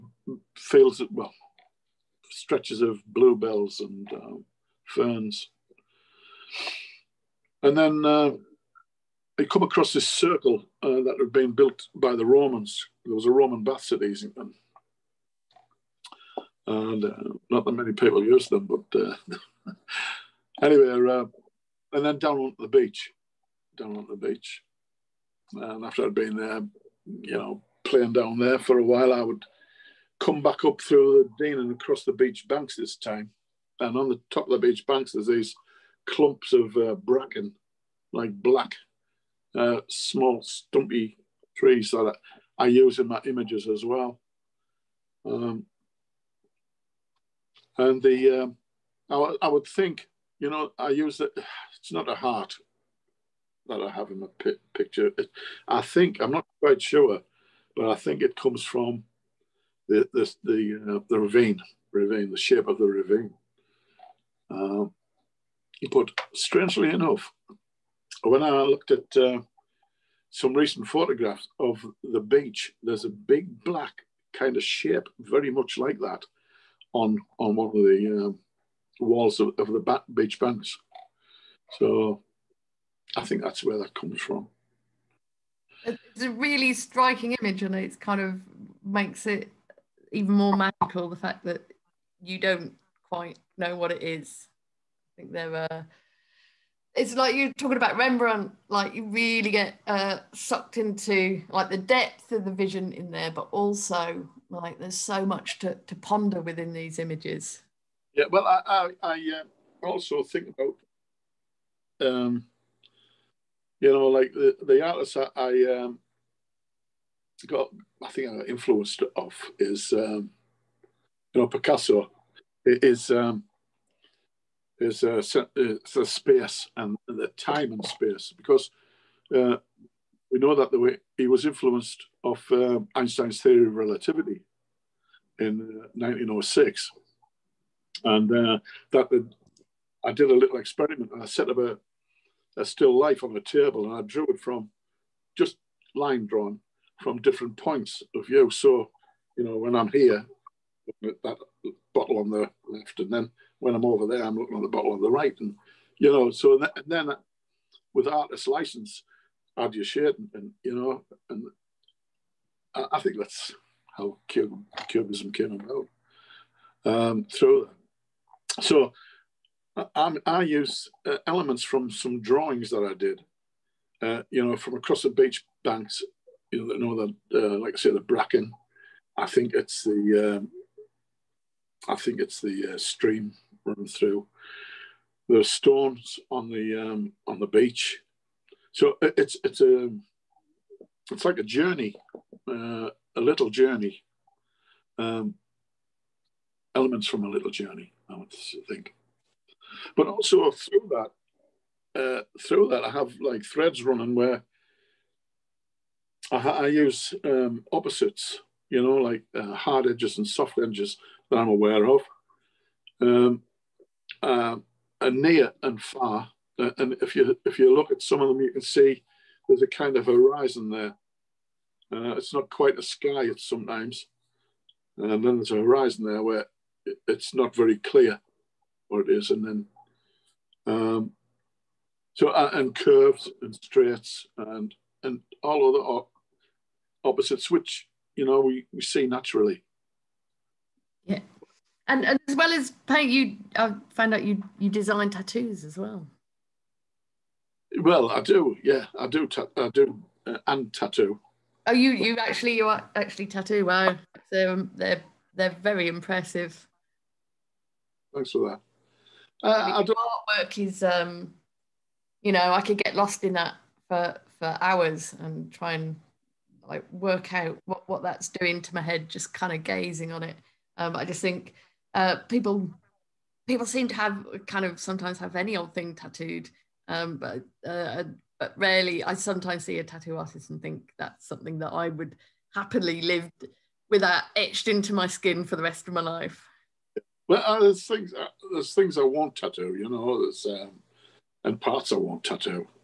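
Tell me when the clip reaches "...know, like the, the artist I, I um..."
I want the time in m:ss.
1:53.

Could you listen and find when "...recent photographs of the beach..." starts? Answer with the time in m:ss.
1:10.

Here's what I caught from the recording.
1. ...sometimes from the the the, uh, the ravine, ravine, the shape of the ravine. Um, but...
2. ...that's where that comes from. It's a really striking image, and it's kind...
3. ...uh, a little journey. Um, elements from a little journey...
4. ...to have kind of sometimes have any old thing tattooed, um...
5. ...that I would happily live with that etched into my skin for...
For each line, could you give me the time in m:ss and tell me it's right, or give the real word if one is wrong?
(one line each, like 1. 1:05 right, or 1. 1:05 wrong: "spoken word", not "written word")
1. 0:58 wrong: "comes", not "sometimes"
2. 1:23 right
3. 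3:12 right
4. 4:33 right
5. 4:41 right.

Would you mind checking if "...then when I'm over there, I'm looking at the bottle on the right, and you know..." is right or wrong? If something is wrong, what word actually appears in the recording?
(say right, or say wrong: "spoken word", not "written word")
right.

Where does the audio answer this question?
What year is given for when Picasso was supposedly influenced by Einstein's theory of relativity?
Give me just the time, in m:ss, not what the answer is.
2:15.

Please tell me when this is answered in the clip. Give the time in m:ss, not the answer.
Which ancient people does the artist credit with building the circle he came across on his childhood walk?
0:12.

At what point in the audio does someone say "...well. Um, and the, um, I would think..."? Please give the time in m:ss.
0:43.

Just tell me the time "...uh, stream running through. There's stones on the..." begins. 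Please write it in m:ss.
3:02.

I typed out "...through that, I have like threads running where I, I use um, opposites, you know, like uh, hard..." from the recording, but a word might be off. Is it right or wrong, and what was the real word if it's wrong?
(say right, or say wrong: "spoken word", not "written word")
right.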